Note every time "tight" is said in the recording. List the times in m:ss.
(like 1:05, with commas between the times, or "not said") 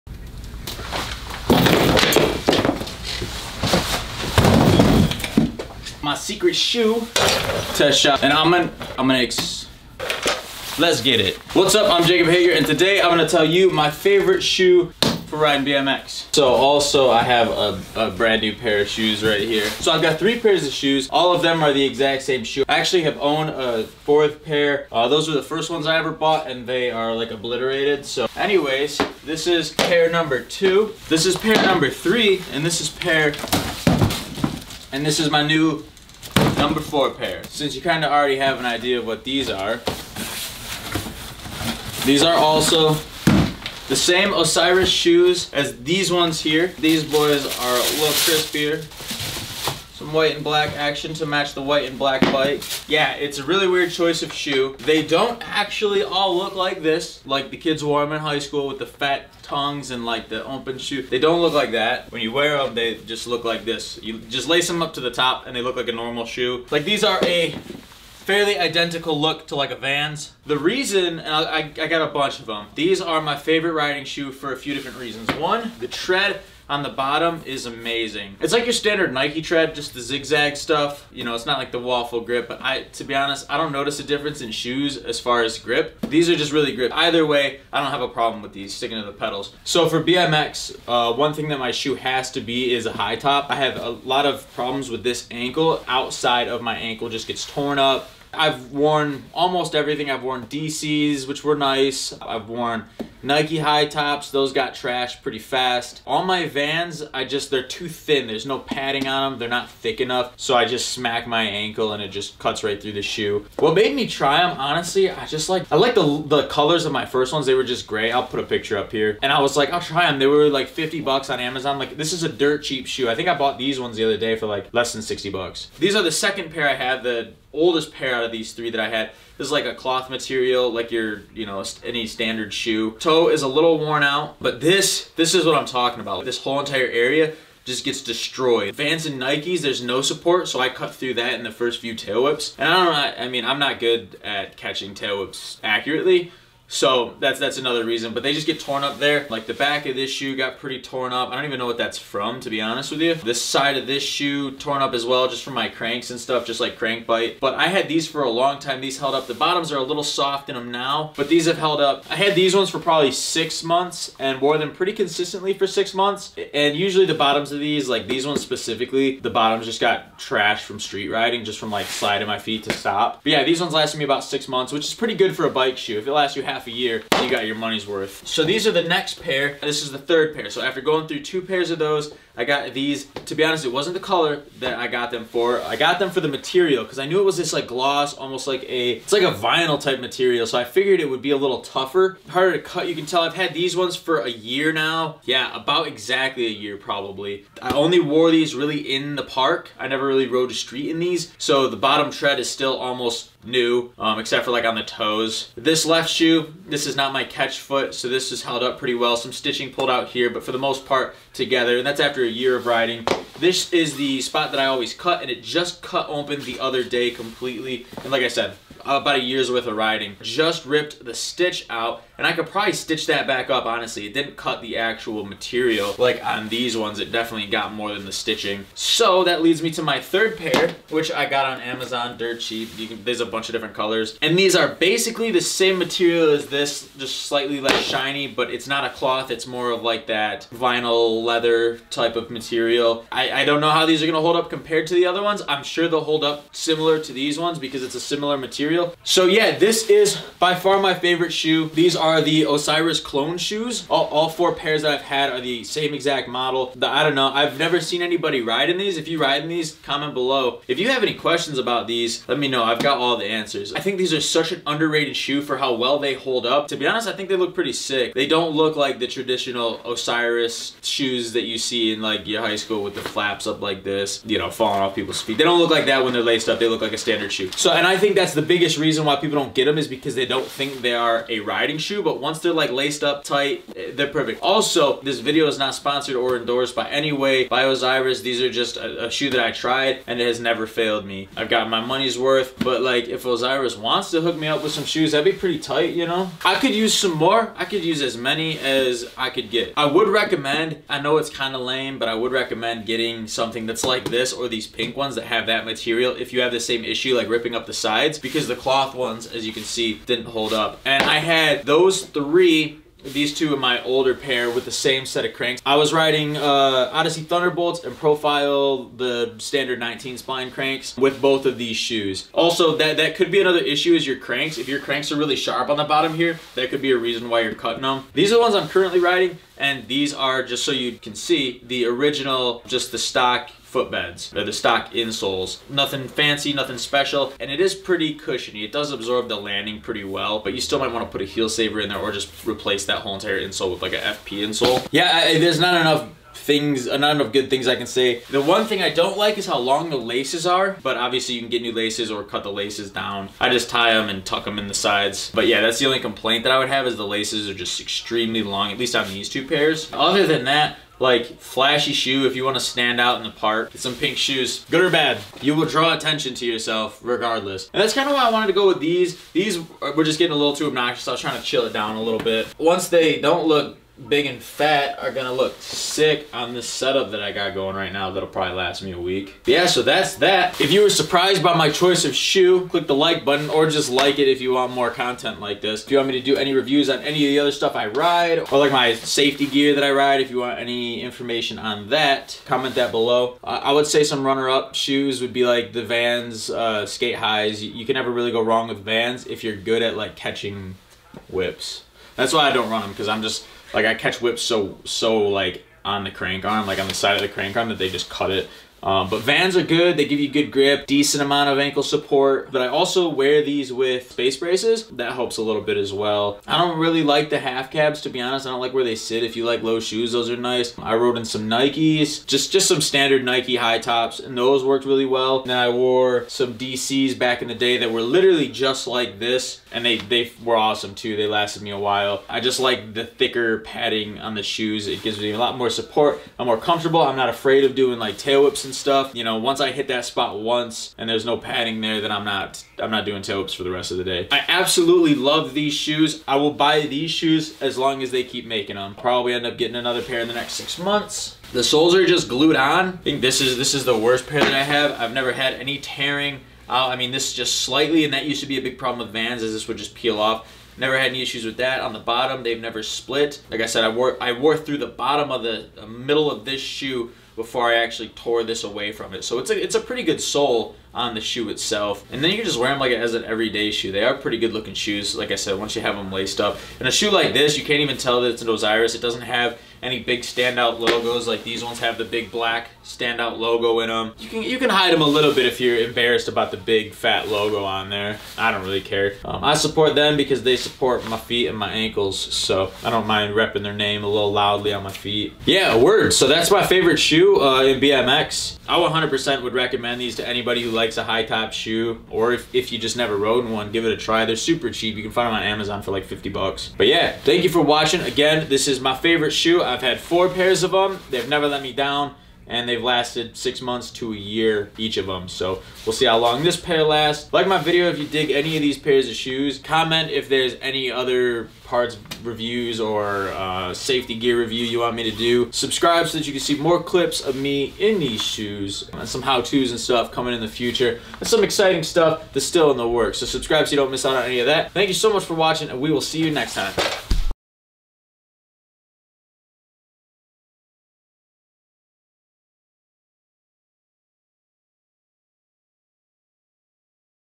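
4:43, 4:55.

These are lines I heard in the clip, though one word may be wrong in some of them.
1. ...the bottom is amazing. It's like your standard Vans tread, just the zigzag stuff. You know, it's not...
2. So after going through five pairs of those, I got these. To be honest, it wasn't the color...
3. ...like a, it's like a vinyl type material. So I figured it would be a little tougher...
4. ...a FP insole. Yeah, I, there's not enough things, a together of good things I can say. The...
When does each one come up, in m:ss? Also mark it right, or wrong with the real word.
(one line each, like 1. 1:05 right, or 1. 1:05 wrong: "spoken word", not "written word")
1. 1:16 wrong: "Nike", not "Vans"
2. 3:00 wrong: "two", not "five"
3. 3:08 right
4. 5:43 wrong: "number", not "together".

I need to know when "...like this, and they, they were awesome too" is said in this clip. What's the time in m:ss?
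7:08.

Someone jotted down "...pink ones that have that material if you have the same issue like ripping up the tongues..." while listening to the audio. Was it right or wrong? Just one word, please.
wrong.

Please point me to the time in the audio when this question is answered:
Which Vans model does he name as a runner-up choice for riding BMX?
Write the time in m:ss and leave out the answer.
6:36.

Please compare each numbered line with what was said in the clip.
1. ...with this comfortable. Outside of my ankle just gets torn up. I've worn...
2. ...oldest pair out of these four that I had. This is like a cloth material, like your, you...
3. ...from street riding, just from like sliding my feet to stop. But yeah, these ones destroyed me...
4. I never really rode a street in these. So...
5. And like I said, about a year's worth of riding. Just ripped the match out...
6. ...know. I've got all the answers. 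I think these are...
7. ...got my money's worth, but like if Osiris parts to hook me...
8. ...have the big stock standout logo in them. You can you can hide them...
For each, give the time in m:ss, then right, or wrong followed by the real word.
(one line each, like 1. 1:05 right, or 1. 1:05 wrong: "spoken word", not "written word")
1. 1:34 wrong: "ankle", not "comfortable"
2. 2:07 wrong: "three", not "four"
3. 2:50 wrong: "lasted", not "destroyed"
4. 3:19 right
5. 3:38 wrong: "stitch", not "match"
6. 4:22 right
7. 4:51 wrong: "wants", not "parts"
8. 8:01 wrong: "black", not "stock".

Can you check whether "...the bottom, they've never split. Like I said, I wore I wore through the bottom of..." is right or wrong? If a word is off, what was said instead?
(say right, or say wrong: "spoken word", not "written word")
right.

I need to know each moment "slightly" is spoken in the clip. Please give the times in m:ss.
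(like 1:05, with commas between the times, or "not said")
3:57, 7:37.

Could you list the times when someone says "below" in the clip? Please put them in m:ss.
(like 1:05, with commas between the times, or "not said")
4:20, 6:32.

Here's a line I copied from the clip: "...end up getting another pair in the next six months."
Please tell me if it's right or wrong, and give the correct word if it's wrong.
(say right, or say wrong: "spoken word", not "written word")
right.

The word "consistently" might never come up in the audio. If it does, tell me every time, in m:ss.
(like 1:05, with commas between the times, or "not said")
2:44.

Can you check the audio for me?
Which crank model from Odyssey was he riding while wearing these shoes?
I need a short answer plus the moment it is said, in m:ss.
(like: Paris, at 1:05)
Thunderbolts, at 5:16.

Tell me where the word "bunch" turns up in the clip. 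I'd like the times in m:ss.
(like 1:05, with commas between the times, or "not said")
1:12, 3:53.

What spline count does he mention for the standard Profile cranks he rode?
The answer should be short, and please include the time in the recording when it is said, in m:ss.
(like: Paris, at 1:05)
19, at 5:19.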